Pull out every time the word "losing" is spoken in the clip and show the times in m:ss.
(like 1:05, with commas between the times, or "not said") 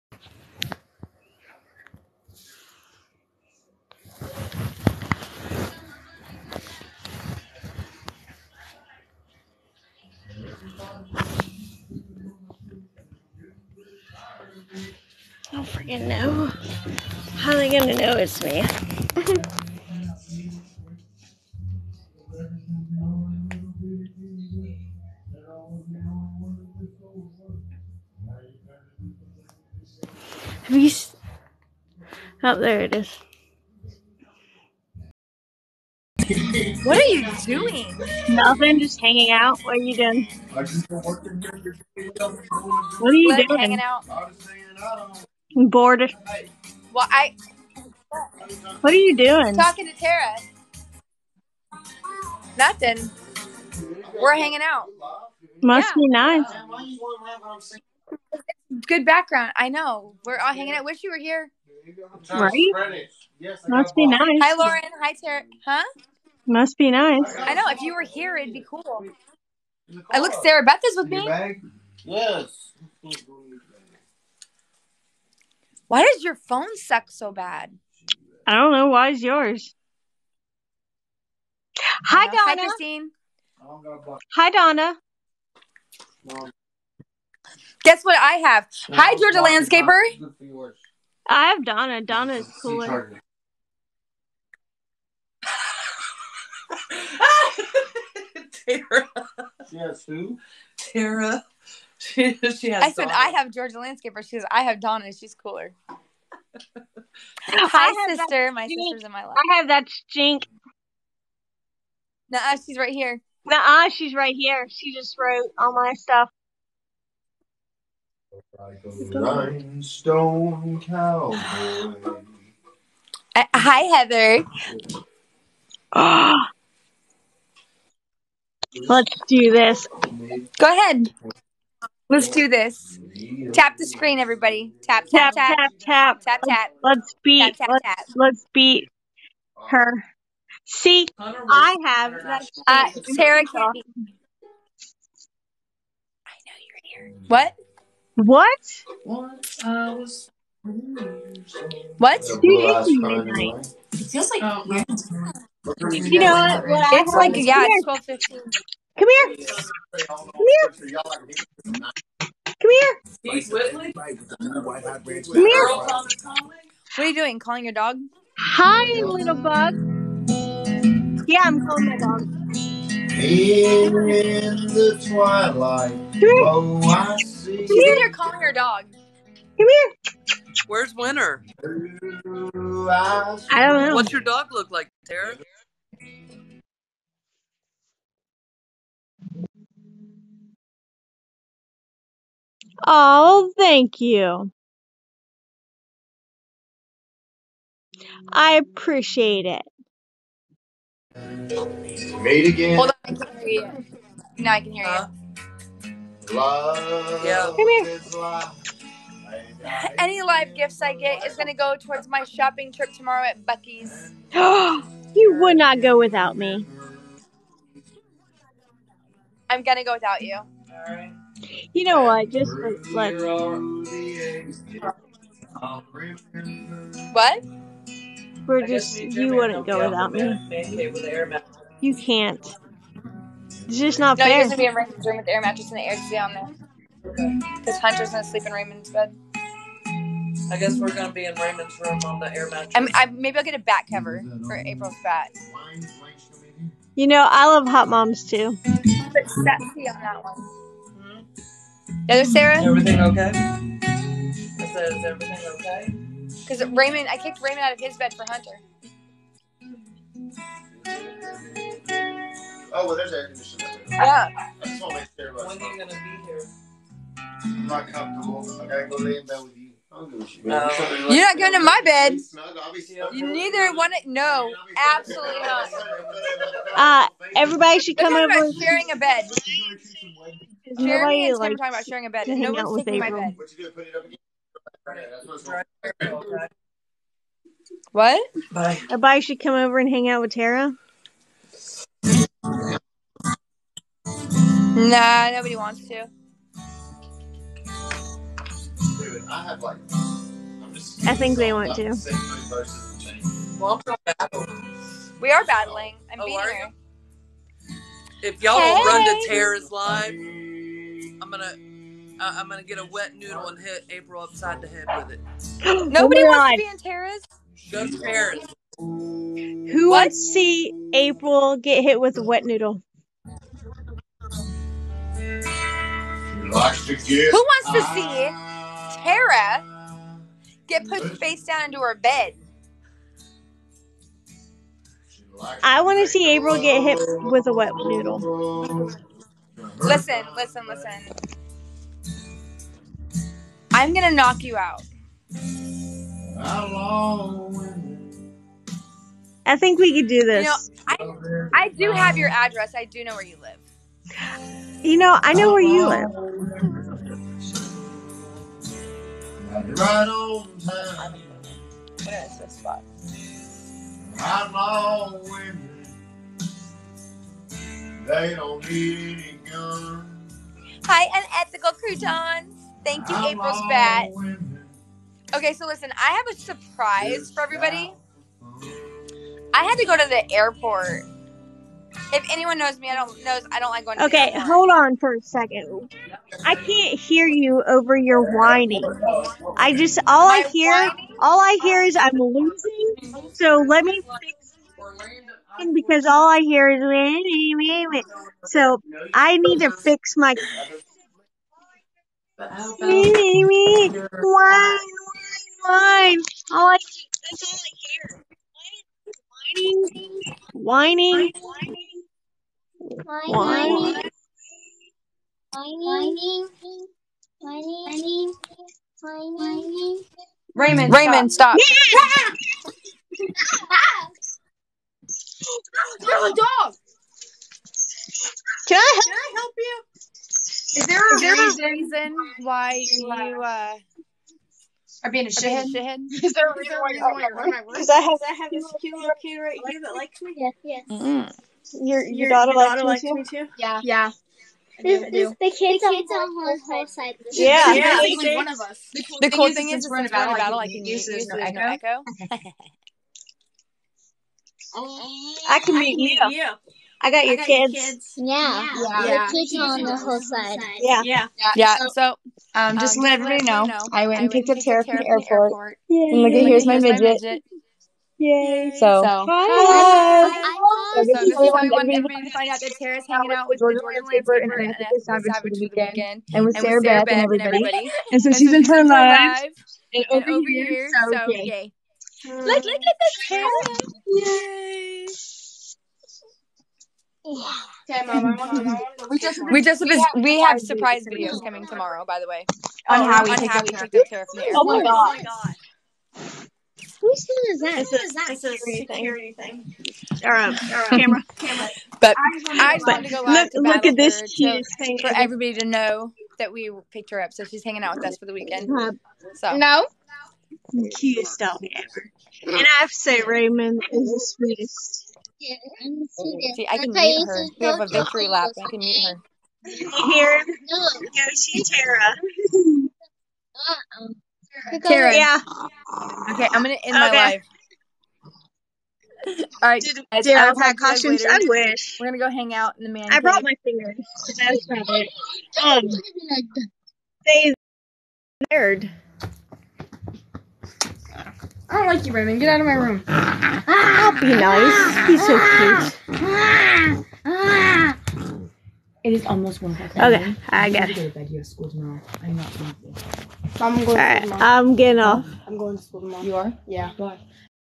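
6:32.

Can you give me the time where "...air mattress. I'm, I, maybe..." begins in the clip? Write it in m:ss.
4:02.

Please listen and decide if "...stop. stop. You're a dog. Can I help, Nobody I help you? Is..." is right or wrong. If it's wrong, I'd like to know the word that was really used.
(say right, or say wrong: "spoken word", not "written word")
wrong: "Can", not "Nobody".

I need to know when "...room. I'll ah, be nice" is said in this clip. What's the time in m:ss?
9:02.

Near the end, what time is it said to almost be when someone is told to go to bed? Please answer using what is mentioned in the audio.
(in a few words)
1:00.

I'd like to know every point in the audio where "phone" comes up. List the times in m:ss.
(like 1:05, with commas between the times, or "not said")
1:16, 8:17.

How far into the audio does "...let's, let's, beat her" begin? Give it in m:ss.
2:17.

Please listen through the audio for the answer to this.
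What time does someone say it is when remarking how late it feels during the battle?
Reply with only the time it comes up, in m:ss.
2:37.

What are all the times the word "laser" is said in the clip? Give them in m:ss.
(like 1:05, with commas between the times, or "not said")
not said.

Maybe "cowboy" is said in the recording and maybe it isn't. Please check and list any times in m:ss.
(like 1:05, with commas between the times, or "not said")
2:00.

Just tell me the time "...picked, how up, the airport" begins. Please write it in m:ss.
8:13.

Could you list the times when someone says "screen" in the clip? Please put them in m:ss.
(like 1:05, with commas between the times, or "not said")
2:13.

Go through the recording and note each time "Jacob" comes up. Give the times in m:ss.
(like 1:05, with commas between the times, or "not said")
not said.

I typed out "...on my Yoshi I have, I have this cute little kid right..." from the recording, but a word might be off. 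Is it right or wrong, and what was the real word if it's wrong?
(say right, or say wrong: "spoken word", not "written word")
wrong: "Because", not "Yoshi".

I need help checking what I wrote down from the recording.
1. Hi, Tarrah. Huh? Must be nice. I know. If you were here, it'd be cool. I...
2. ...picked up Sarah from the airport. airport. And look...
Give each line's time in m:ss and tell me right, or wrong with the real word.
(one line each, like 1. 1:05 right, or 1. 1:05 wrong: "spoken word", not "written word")
1. 1:04 right
2. 7:44 wrong: "Tarrah", not "Sarah".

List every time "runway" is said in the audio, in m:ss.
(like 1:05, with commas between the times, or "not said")
not said.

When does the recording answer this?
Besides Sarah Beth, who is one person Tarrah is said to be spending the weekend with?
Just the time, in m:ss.
7:53.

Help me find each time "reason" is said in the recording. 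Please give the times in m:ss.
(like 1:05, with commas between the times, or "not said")
7:11, 7:16.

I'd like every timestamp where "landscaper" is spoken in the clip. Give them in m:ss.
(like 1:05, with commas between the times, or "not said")
1:29, 1:43.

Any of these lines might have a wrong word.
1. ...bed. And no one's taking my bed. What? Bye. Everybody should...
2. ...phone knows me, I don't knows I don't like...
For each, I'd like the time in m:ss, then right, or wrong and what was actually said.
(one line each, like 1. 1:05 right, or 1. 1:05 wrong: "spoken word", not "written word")
1. 4:42 right
2. 6:22 wrong: "anyone", not "phone".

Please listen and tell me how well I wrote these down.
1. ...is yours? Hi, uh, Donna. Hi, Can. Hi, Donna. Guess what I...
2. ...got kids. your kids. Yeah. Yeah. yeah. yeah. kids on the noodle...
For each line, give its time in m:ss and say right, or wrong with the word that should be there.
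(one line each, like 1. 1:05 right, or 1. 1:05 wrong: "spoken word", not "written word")
1. 1:19 wrong: "Christine", not "Can"
2. 7:37 wrong: "whole", not "noodle".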